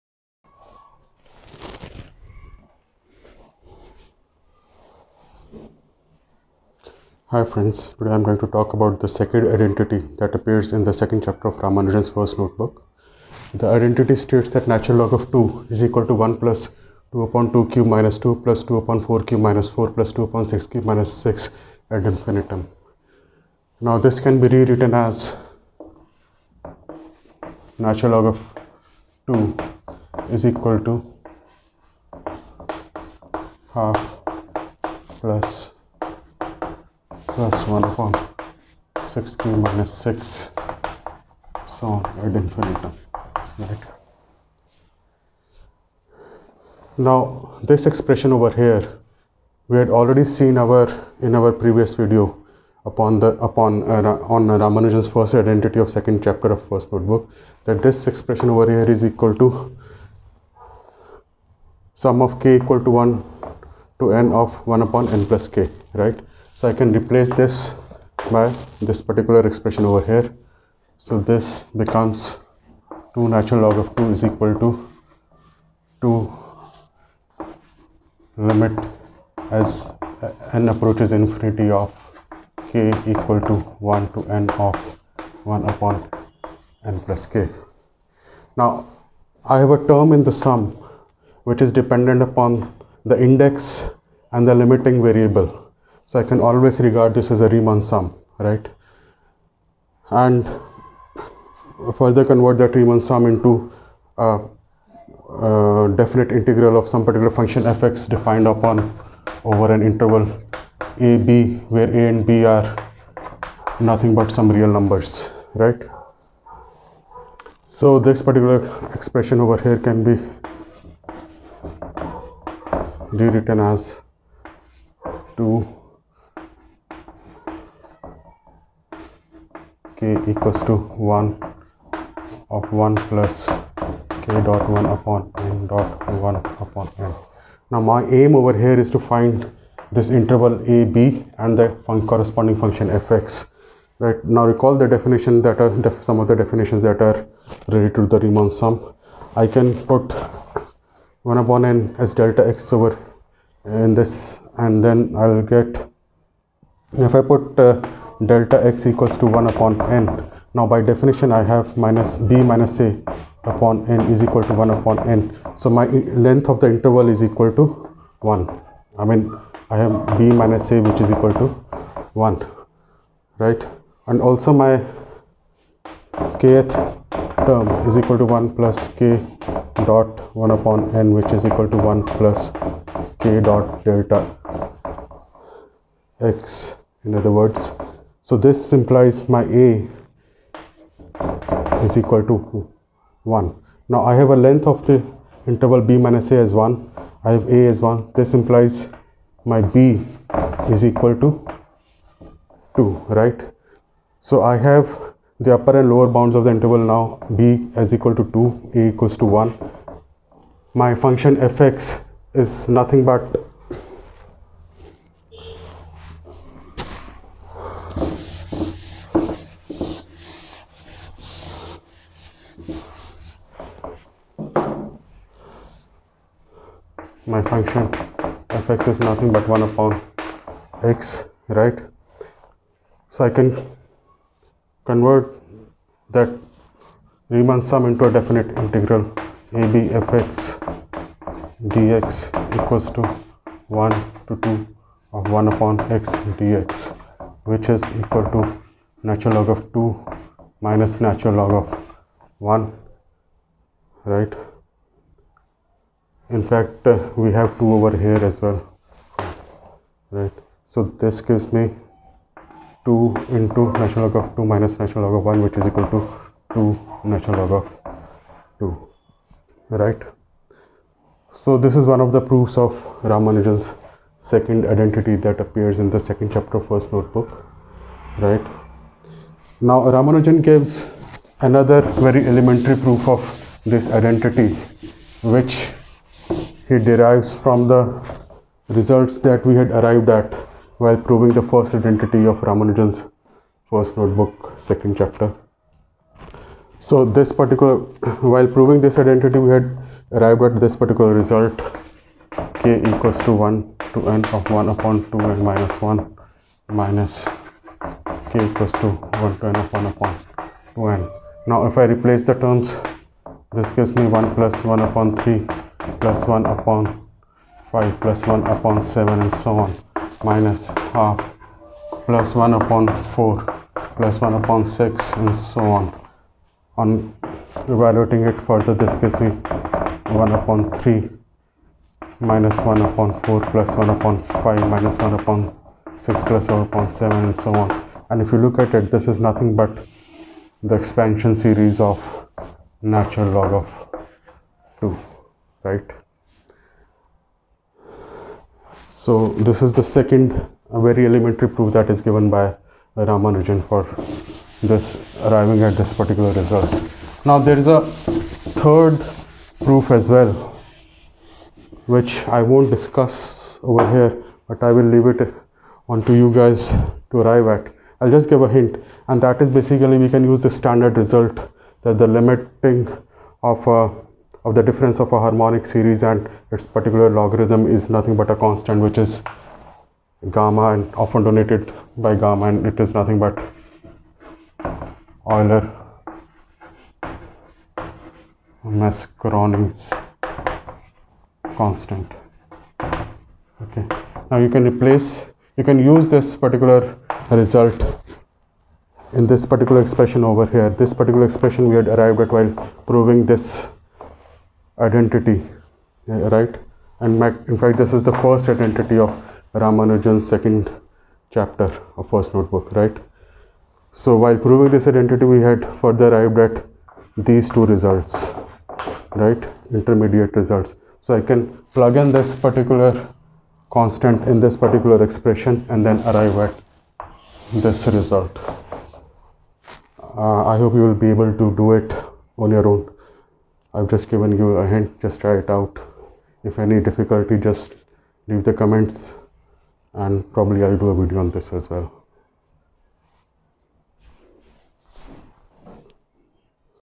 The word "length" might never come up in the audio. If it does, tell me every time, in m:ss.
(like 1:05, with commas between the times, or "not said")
2:45, 3:14.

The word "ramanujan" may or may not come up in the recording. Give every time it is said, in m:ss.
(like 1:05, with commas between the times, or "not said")
0:11, 0:54, 4:33, 4:39, 4:52, 5:52, 6:49.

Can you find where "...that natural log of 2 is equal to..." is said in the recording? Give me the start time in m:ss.
0:14.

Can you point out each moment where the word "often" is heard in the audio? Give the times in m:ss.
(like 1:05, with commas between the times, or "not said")
6:20.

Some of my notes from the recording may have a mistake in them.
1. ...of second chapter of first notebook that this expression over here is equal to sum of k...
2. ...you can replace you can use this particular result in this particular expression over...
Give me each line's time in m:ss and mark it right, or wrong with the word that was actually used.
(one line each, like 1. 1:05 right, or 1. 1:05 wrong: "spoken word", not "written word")
1. 0:55 right
2. 6:34 right.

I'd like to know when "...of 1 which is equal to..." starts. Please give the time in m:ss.
4:25.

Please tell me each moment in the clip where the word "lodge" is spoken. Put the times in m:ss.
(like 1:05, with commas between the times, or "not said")
not said.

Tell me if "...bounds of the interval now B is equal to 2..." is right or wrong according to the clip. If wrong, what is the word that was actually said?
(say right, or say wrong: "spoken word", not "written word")
right.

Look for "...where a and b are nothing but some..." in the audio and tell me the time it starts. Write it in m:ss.
1:51.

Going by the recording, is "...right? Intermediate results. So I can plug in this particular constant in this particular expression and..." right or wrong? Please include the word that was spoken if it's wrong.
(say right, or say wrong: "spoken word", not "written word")
right.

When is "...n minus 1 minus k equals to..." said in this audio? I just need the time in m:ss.
5:05.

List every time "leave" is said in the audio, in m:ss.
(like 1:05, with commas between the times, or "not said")
6:04, 7:18.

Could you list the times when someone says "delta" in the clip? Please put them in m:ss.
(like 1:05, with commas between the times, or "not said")
2:32, 2:38, 3:03.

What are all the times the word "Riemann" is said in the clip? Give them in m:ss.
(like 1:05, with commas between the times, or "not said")
1:37, 1:42, 2:28, 3:57.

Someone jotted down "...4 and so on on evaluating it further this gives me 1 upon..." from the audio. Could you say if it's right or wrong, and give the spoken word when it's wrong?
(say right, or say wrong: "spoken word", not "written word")
wrong: "6", not "4".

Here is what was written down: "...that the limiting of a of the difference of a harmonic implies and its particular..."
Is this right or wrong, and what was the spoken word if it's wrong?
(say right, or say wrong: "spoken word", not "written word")
wrong: "series", not "implies".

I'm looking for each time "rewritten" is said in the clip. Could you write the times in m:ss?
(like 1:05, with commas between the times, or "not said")
0:24, 2:03.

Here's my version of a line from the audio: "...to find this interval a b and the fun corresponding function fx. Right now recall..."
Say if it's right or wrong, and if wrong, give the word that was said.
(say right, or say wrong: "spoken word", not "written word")
right.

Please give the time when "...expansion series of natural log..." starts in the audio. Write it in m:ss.
5:40.